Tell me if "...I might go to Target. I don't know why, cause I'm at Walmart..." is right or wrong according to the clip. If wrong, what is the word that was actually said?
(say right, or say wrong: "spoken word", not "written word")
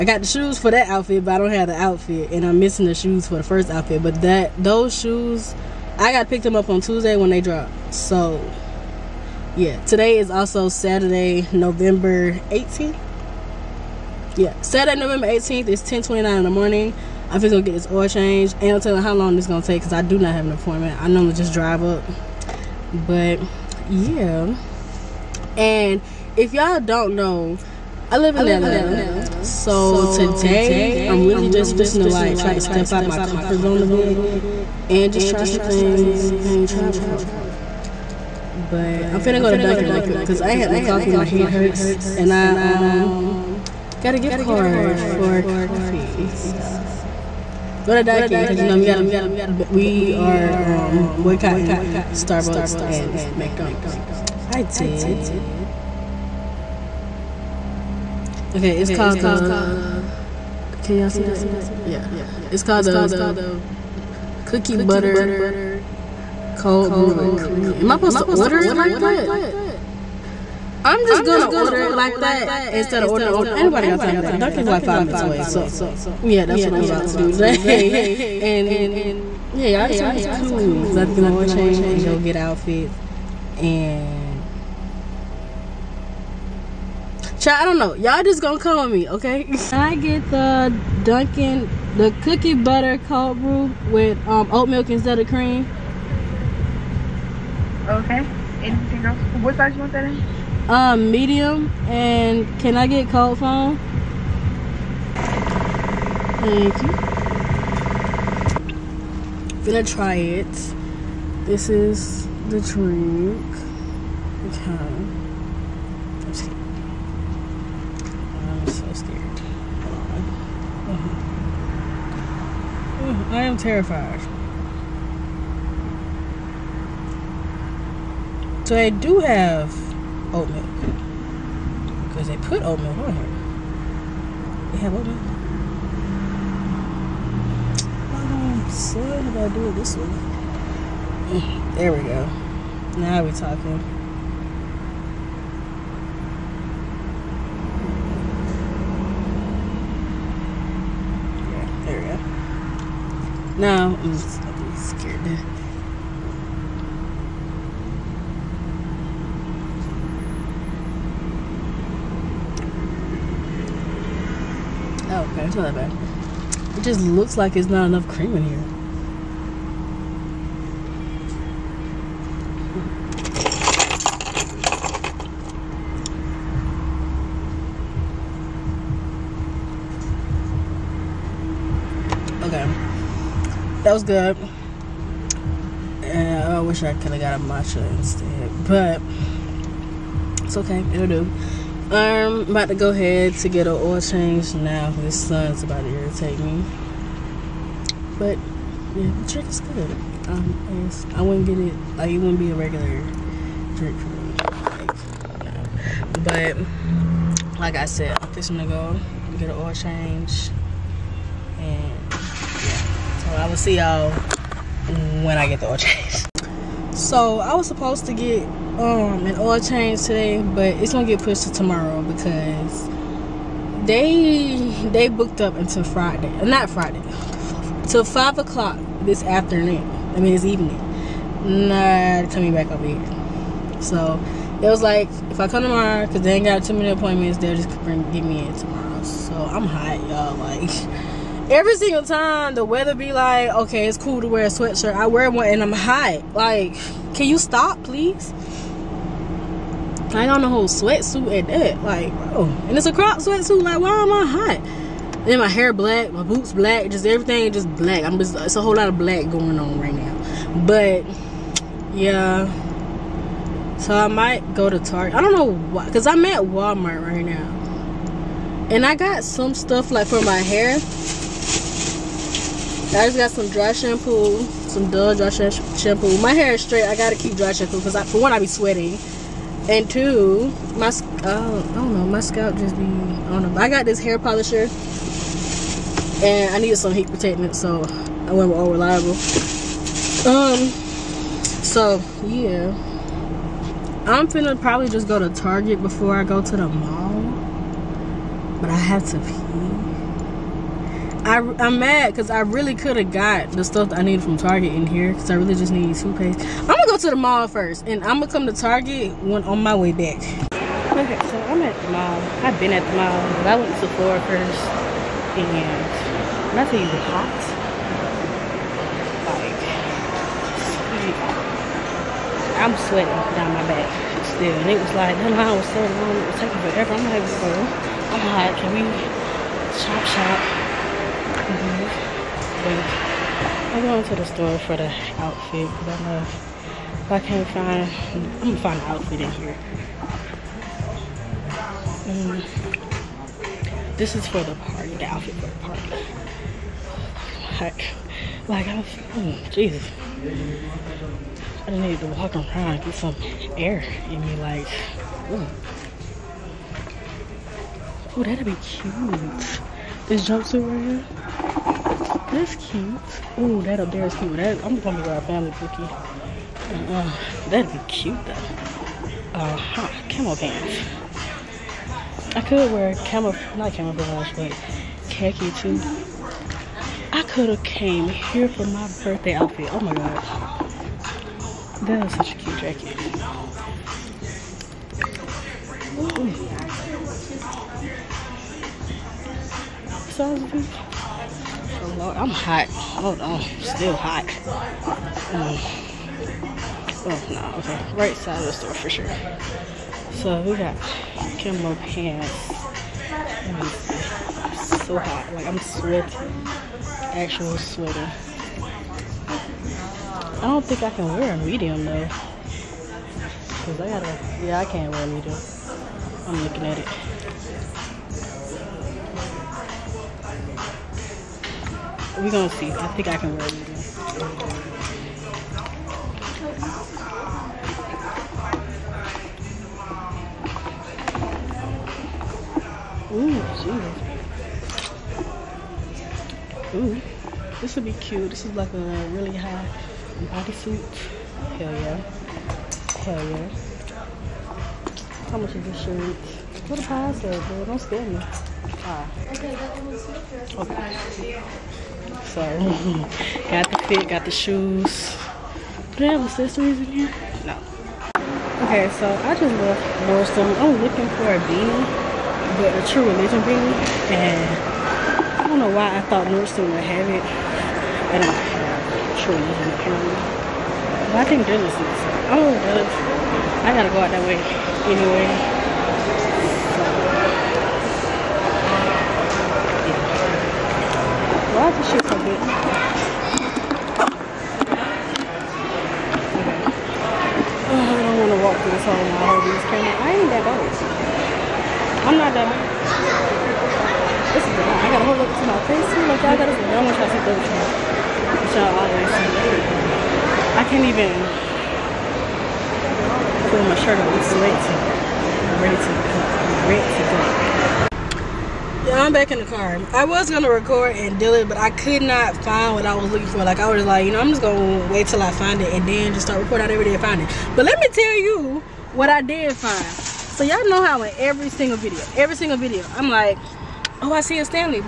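right.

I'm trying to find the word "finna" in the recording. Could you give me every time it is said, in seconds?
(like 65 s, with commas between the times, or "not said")
39 s, 294 s.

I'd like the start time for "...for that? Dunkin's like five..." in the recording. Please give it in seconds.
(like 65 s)
74 s.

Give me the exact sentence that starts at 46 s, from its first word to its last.
So go to Dunkin' because you know we gotta we are um boycotting Starbucks and McDonald's.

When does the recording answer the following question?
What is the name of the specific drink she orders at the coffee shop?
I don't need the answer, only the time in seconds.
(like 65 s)
92 s.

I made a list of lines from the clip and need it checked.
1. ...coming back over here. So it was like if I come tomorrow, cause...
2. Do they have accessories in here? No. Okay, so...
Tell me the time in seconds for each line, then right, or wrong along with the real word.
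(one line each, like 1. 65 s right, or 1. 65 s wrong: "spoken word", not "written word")
1. 232 s right
2. 455 s right.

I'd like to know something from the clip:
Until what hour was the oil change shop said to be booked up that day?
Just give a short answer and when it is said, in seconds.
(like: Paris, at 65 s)
5 o'clock, at 228 s.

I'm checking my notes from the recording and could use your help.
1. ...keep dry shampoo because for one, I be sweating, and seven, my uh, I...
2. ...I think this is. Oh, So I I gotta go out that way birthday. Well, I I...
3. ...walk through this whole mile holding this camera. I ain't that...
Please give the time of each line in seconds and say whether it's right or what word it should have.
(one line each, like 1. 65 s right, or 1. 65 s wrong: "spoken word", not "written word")
1. 277 s wrong: "two", not "seven"
2. 471 s wrong: "anyway", not "birthday"
3. 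488 s right.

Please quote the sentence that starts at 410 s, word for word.
I don't think I can wear a medium though.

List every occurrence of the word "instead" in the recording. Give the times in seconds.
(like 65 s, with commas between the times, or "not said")
72 s, 94 s, 187 s.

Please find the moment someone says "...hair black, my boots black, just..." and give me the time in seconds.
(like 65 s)
255 s.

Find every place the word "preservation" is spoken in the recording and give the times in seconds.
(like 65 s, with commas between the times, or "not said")
not said.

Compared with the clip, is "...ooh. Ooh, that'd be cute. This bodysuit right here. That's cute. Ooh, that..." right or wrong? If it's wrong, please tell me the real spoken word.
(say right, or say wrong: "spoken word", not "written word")
wrong: "jumpsuit", not "bodysuit".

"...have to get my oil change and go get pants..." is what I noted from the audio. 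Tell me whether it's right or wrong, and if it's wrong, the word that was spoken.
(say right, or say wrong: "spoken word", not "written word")
wrong: "outfits", not "pants".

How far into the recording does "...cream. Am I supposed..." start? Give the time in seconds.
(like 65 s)
67 s.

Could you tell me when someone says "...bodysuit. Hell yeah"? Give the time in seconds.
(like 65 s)
440 s.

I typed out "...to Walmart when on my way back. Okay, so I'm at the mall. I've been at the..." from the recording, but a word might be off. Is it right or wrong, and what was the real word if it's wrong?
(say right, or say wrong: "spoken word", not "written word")
wrong: "Target", not "Walmart".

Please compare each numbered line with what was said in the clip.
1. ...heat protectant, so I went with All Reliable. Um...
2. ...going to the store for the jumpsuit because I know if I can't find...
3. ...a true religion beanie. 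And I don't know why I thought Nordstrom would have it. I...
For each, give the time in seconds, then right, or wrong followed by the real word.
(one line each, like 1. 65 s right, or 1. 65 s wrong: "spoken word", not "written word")
1. 286 s right
2. 333 s wrong: "outfit", not "jumpsuit"
3. 462 s right.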